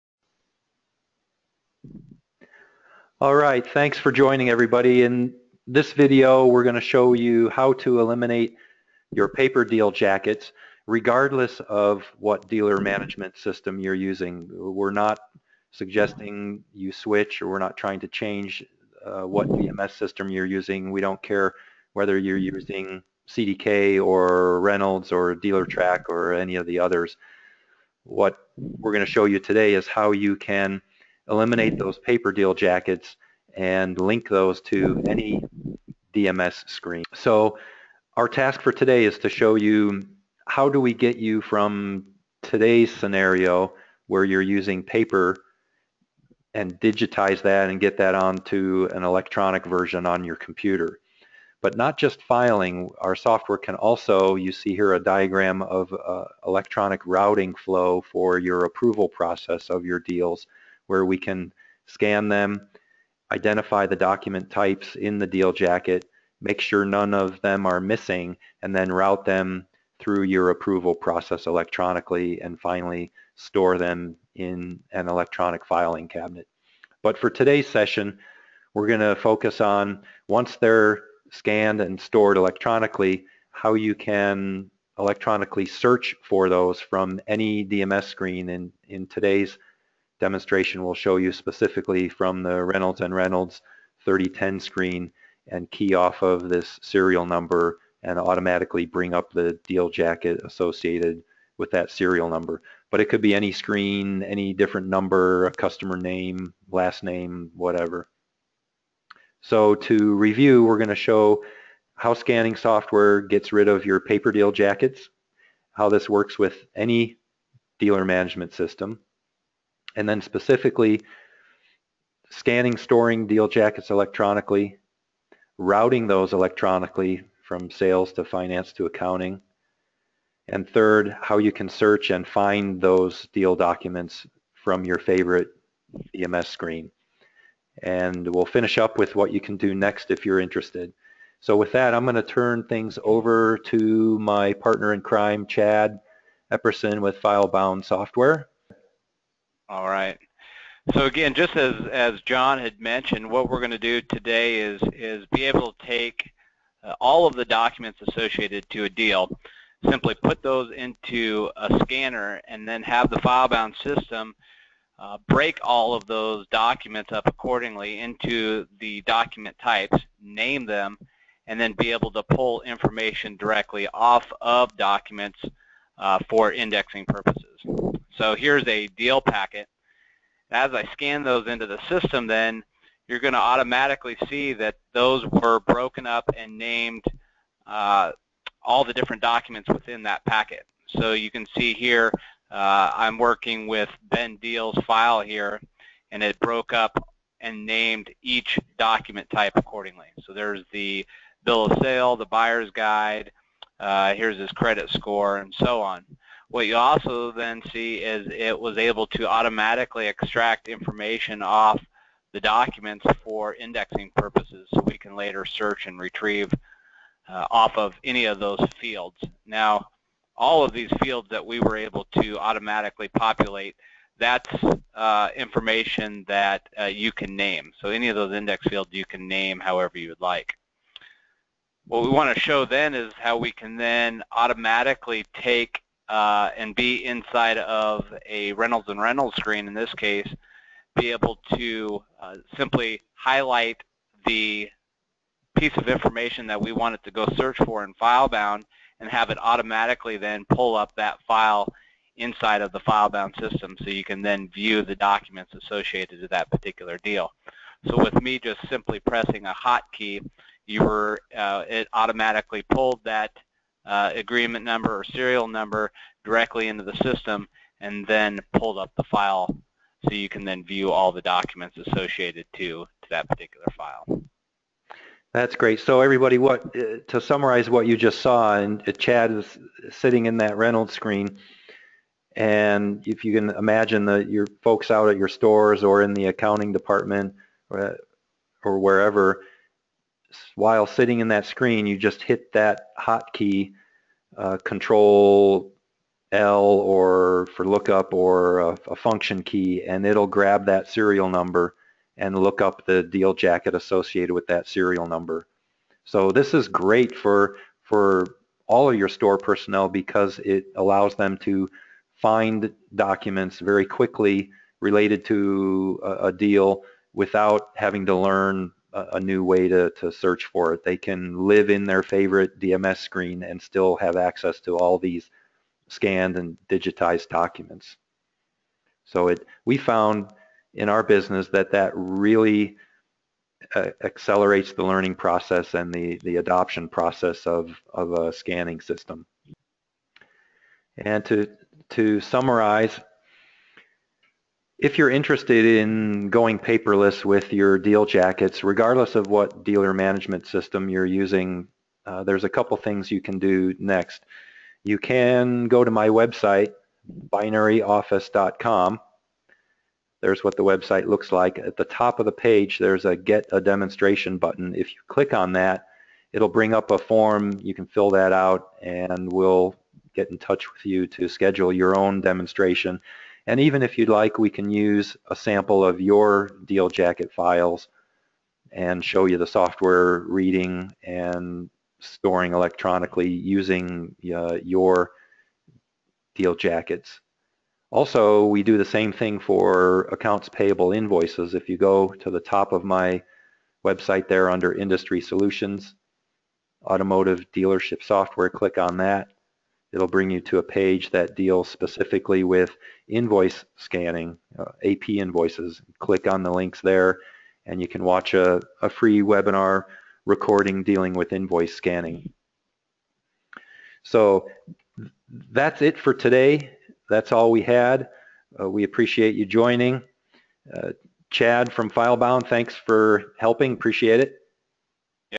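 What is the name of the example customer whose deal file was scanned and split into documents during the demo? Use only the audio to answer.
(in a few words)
Ben Deal.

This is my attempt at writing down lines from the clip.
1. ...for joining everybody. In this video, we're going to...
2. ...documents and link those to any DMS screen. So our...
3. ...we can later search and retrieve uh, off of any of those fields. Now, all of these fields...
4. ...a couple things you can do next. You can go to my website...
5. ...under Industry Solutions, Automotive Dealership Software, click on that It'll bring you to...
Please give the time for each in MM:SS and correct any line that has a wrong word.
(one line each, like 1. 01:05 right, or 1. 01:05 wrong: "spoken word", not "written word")
1. 00:03 right
2. 00:32 wrong: "jackets", not "documents"
3. 03:34 right
4. 05:52 right
5. 06:34 right.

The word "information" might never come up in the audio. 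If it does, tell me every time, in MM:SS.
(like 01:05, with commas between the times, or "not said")
02:52, 03:30, 03:45, 04:05.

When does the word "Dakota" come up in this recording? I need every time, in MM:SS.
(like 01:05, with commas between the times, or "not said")
not said.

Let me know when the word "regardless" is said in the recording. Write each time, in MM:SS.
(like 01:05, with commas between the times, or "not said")
00:10, 05:48.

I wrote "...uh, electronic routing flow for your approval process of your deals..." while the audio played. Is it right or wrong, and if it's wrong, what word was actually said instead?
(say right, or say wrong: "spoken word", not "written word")
right.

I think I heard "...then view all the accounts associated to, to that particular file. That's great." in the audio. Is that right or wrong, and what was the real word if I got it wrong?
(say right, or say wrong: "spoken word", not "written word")
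wrong: "documents", not "accounts".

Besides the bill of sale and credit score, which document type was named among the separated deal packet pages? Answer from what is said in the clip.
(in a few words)
buyer's guide.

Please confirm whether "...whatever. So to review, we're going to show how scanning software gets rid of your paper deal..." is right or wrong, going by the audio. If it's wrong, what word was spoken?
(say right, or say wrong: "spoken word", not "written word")
right.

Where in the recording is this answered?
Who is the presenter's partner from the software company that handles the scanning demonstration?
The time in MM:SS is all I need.
02:25.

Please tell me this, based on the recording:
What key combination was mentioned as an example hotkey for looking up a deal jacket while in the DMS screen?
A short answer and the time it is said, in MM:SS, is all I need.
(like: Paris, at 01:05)
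Control L, at 04:54.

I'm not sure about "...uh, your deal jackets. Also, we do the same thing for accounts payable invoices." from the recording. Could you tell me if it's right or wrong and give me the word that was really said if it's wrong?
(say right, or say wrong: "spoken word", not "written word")
right.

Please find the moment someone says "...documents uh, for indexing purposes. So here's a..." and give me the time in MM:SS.
02:54.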